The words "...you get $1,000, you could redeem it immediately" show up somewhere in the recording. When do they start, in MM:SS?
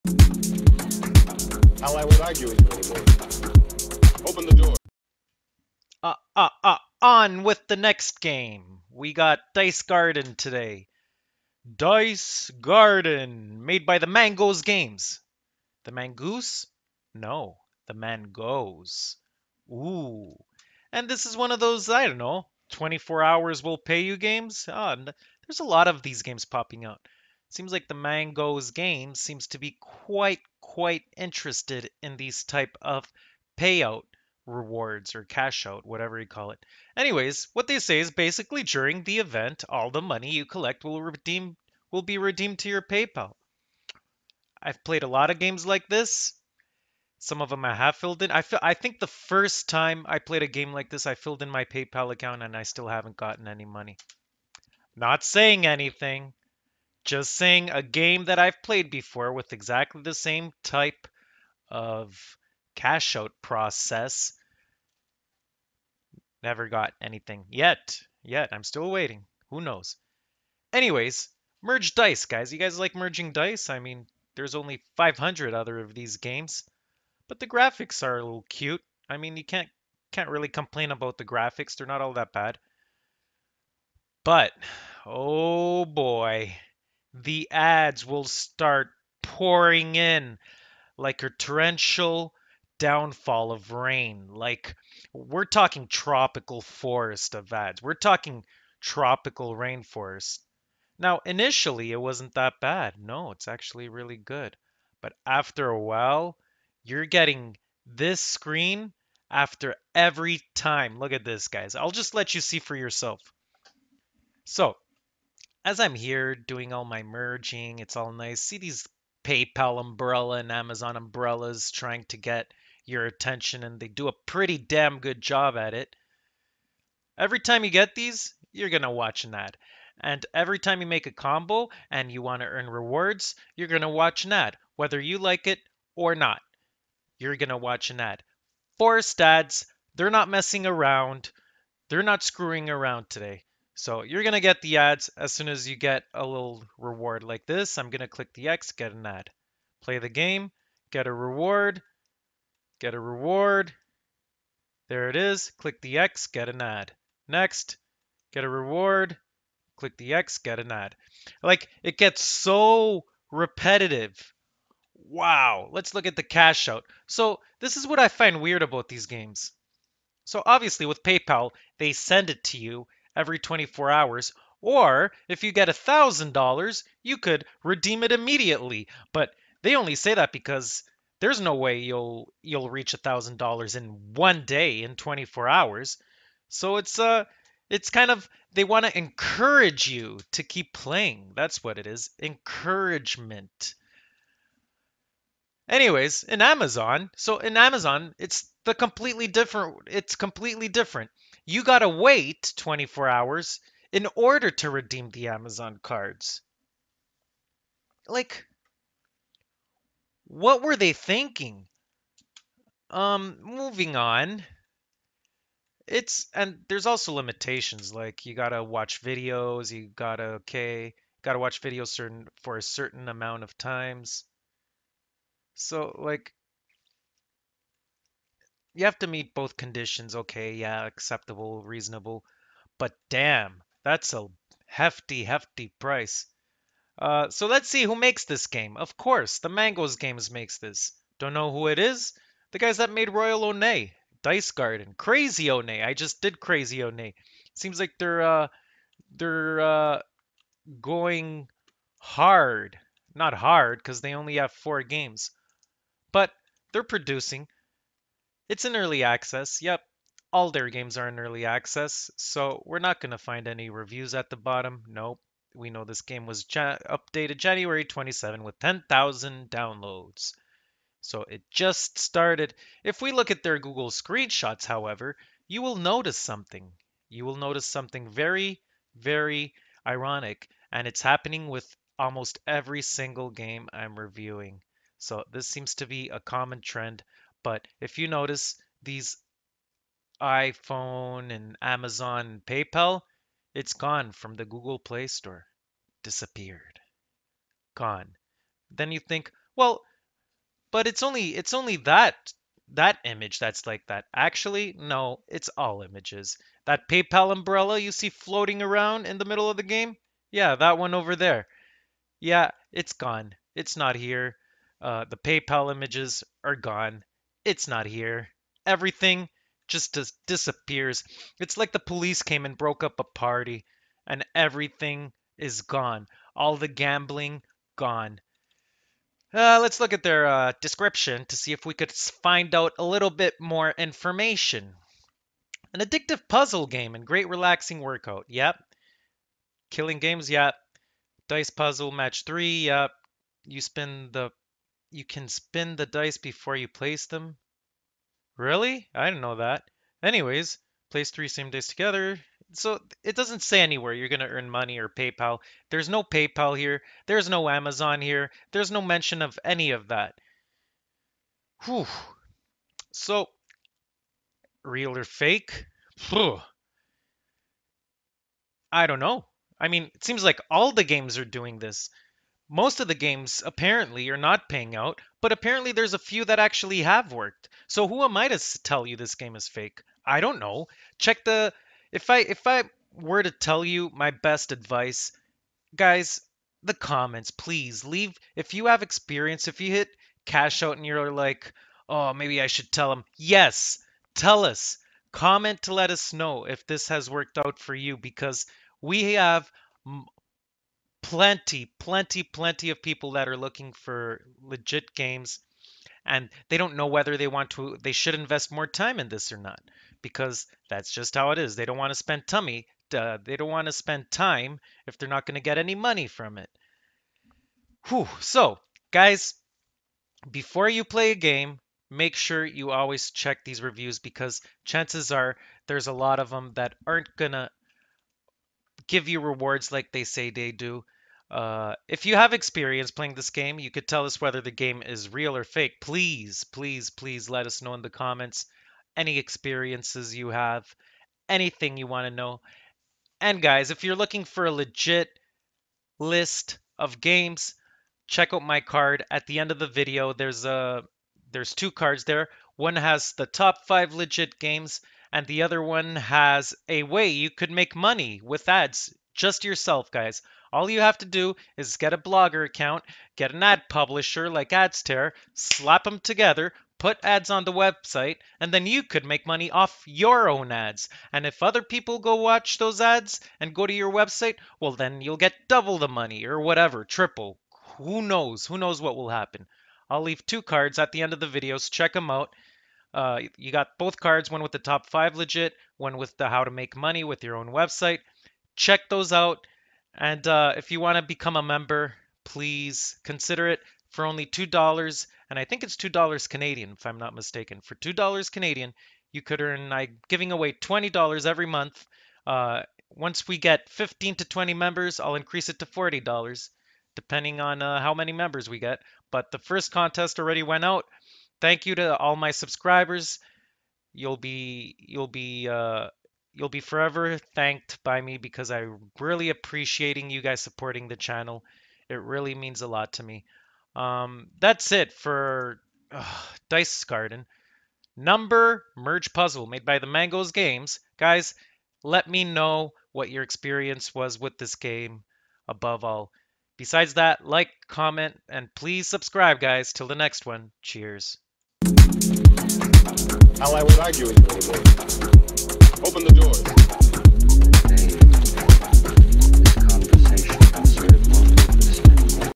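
02:55.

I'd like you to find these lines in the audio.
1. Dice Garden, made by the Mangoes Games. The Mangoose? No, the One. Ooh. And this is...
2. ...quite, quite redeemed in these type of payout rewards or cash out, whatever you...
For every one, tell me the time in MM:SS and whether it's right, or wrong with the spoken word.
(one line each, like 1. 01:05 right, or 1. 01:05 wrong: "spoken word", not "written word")
1. 00:11 wrong: "Mangoes", not "One"
2. 00:29 wrong: "interested", not "redeemed".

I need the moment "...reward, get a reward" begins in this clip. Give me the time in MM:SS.
02:31.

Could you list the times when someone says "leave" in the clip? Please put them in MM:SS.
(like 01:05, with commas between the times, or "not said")
06:27, 08:00.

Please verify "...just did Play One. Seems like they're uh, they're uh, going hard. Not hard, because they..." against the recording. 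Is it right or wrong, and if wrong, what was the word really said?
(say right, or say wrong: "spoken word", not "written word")
wrong: "Crazy", not "Play".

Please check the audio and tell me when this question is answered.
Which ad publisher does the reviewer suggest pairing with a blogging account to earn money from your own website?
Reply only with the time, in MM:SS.
07:44.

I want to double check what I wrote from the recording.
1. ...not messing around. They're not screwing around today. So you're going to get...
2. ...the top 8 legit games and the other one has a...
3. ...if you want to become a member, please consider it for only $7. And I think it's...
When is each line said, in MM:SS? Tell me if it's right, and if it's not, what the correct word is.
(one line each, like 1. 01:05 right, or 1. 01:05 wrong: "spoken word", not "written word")
1. 02:20 right
2. 07:33 wrong: "5", not "8"
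3. 08:10 wrong: "2", not "7".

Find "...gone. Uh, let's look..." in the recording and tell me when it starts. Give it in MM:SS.
05:27.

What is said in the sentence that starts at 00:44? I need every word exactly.
I've played a lot of games like this.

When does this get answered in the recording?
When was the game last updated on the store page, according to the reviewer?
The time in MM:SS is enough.
04:27.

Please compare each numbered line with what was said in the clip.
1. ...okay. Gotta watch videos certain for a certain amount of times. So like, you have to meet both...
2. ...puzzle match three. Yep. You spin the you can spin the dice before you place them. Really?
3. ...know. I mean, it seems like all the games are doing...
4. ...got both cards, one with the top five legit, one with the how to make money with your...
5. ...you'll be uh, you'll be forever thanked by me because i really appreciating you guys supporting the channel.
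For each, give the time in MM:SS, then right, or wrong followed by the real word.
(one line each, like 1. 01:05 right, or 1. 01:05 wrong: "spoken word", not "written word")
1. 03:40 right
2. 05:41 right
3. 06:08 right
4. 08:03 right
5. 08:34 right.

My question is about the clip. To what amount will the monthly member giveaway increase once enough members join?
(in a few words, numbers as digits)
$40.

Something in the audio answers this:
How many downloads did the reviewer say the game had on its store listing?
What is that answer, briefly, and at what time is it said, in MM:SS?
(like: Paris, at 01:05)
10,000, at 04:28.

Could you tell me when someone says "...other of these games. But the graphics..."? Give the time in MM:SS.
01:15.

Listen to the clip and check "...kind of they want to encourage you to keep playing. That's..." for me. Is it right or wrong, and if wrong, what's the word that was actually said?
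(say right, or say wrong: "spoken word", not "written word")
right.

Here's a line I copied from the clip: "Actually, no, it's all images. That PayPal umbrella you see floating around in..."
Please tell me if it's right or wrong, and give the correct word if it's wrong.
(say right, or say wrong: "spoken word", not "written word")
right.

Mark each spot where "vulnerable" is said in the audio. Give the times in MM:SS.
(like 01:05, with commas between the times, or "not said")
not said.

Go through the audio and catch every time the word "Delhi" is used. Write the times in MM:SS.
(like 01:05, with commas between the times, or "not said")
not said.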